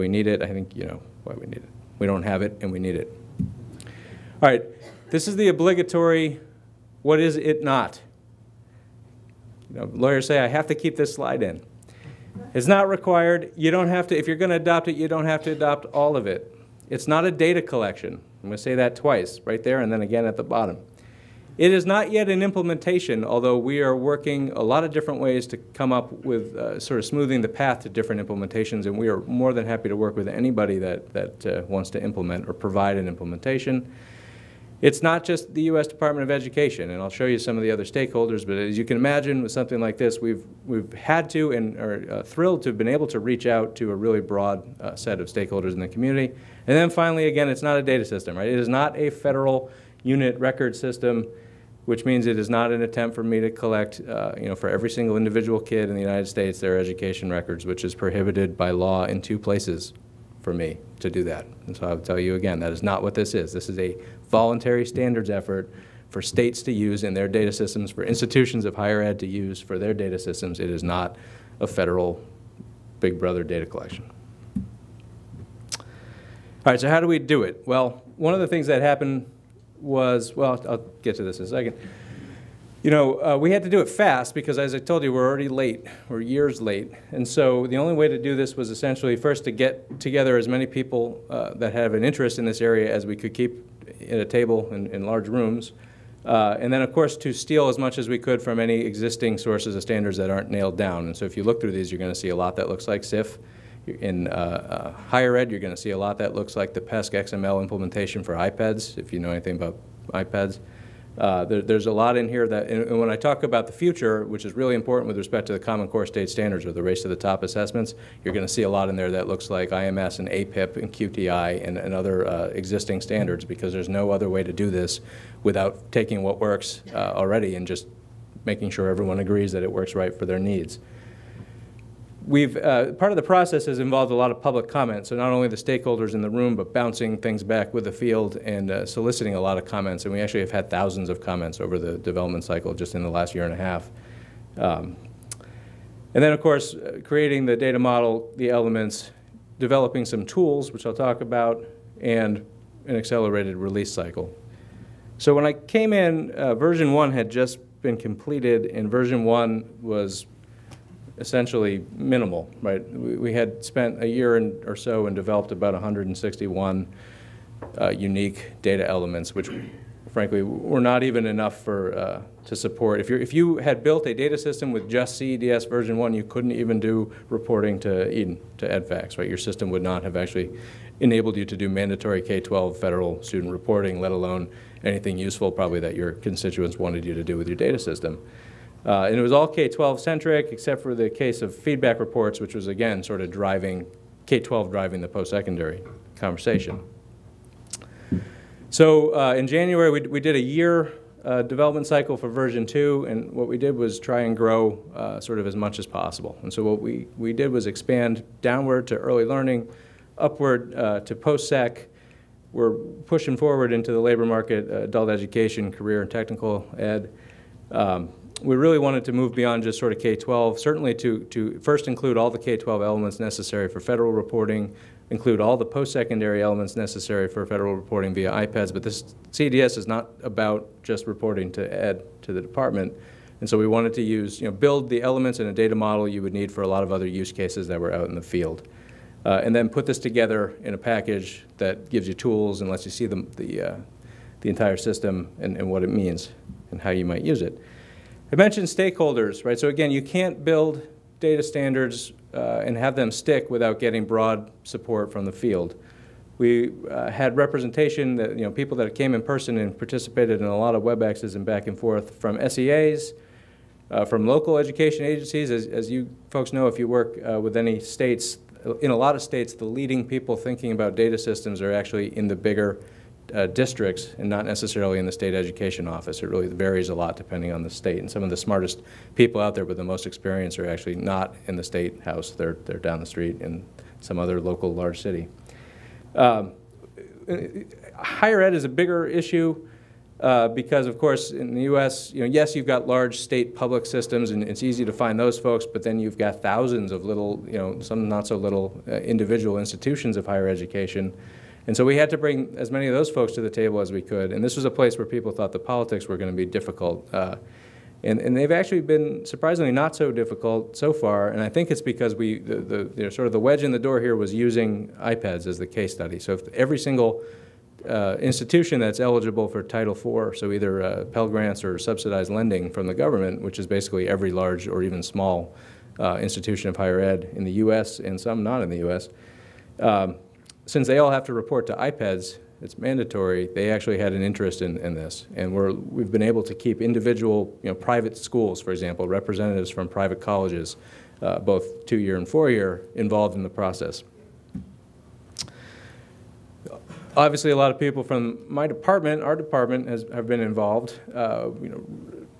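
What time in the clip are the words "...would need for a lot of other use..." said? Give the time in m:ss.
3:56.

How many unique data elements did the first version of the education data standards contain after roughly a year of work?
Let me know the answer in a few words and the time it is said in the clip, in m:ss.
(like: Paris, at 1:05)
161, at 2:45.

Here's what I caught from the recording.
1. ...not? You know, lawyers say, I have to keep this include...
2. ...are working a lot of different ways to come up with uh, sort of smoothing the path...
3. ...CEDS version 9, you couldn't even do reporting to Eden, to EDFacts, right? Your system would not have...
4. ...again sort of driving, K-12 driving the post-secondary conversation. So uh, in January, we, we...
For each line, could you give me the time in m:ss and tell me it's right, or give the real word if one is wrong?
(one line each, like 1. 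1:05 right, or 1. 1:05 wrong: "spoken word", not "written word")
1. 0:07 wrong: "slide", not "include"
2. 0:23 right
3. 2:55 wrong: "1", not "9"
4. 3:12 right.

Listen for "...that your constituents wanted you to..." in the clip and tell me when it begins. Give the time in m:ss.
3:05.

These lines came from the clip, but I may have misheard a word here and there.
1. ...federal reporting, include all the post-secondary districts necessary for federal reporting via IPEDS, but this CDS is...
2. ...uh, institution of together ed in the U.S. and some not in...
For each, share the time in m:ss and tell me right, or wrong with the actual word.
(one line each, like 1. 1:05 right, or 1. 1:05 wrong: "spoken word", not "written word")
1. 3:43 wrong: "elements", not "districts"
2. 5:25 wrong: "higher", not "together".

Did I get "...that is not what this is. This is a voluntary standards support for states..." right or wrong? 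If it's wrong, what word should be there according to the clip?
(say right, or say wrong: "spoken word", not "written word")
wrong: "effort", not "support".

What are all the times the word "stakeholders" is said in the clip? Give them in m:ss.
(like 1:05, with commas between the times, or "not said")
0:37, 0:45, 2:15, 4:08.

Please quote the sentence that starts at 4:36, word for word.
It really varies a lot depending on the state.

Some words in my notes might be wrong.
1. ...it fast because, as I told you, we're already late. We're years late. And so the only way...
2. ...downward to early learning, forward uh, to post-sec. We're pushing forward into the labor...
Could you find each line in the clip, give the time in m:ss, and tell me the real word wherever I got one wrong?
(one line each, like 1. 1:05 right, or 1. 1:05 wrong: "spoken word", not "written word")
1. 1:23 right
2. 3:28 wrong: "upward", not "forward".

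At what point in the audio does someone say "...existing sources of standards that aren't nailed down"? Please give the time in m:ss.
1:38.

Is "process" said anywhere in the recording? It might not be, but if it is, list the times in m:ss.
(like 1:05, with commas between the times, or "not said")
2:13, 5:43.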